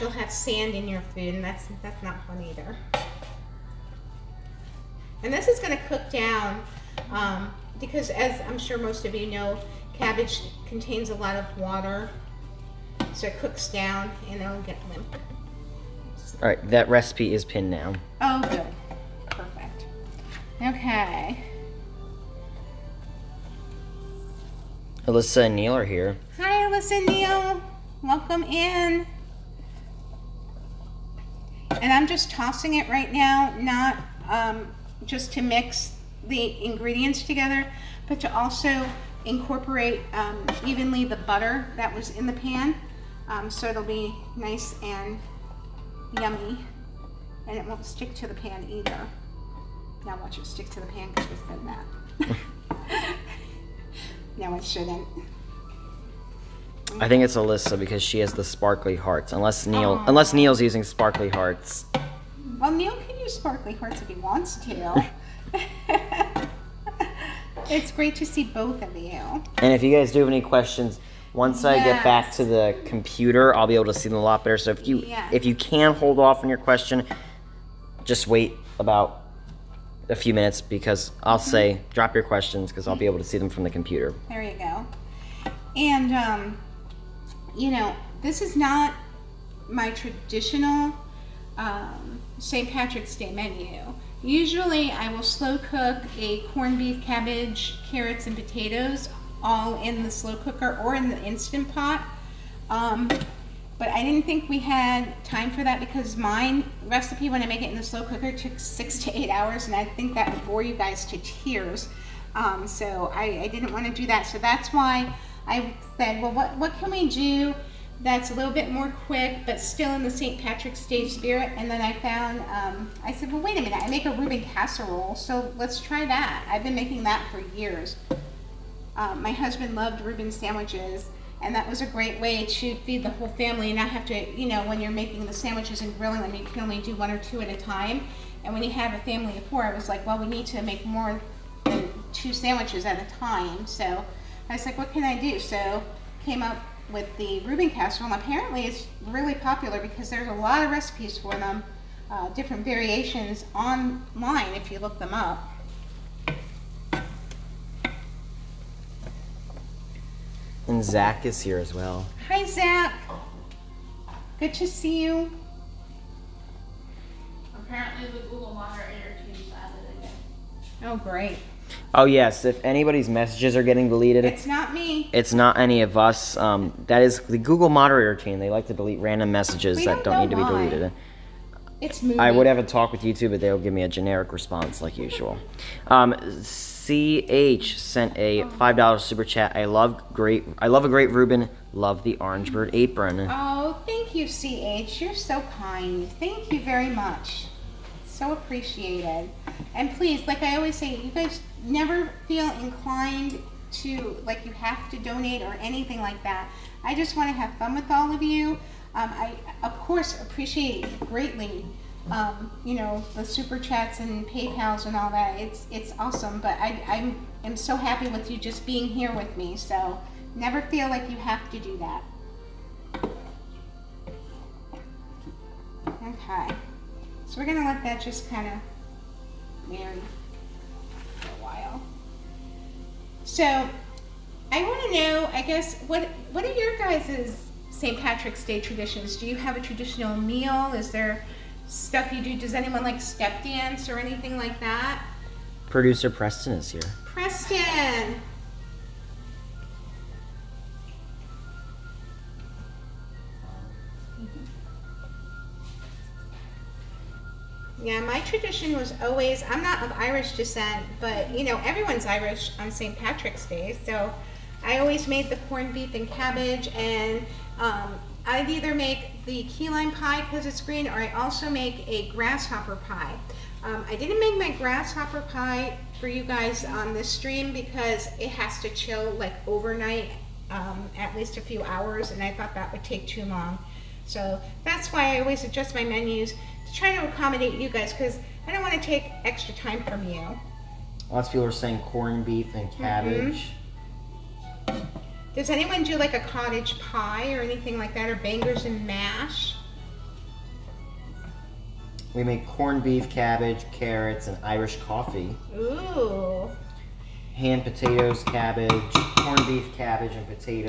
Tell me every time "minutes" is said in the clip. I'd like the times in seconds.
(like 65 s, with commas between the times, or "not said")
80 s, 123 s.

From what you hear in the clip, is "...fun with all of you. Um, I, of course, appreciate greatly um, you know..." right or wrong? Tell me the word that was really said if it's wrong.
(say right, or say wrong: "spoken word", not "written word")
right.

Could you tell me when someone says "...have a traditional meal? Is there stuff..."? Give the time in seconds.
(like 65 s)
239 s.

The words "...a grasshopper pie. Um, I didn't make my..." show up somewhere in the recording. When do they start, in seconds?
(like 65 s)
271 s.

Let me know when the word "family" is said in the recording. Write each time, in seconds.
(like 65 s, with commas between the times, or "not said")
133 s, 139 s.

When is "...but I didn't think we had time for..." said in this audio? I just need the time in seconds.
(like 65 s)
103 s.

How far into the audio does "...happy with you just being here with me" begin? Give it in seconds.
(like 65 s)
217 s.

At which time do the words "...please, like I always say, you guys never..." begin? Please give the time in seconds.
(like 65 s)
199 s.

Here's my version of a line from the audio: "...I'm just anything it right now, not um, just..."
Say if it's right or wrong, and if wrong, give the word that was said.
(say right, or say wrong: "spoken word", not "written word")
wrong: "tossing", not "anything".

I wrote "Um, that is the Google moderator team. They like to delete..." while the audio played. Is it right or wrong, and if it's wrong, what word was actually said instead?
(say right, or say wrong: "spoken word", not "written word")
right.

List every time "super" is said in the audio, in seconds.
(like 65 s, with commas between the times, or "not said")
189 s, 213 s.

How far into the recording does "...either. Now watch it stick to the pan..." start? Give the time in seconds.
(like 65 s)
48 s.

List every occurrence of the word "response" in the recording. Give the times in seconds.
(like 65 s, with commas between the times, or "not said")
184 s.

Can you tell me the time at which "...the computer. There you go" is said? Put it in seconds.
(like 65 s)
83 s.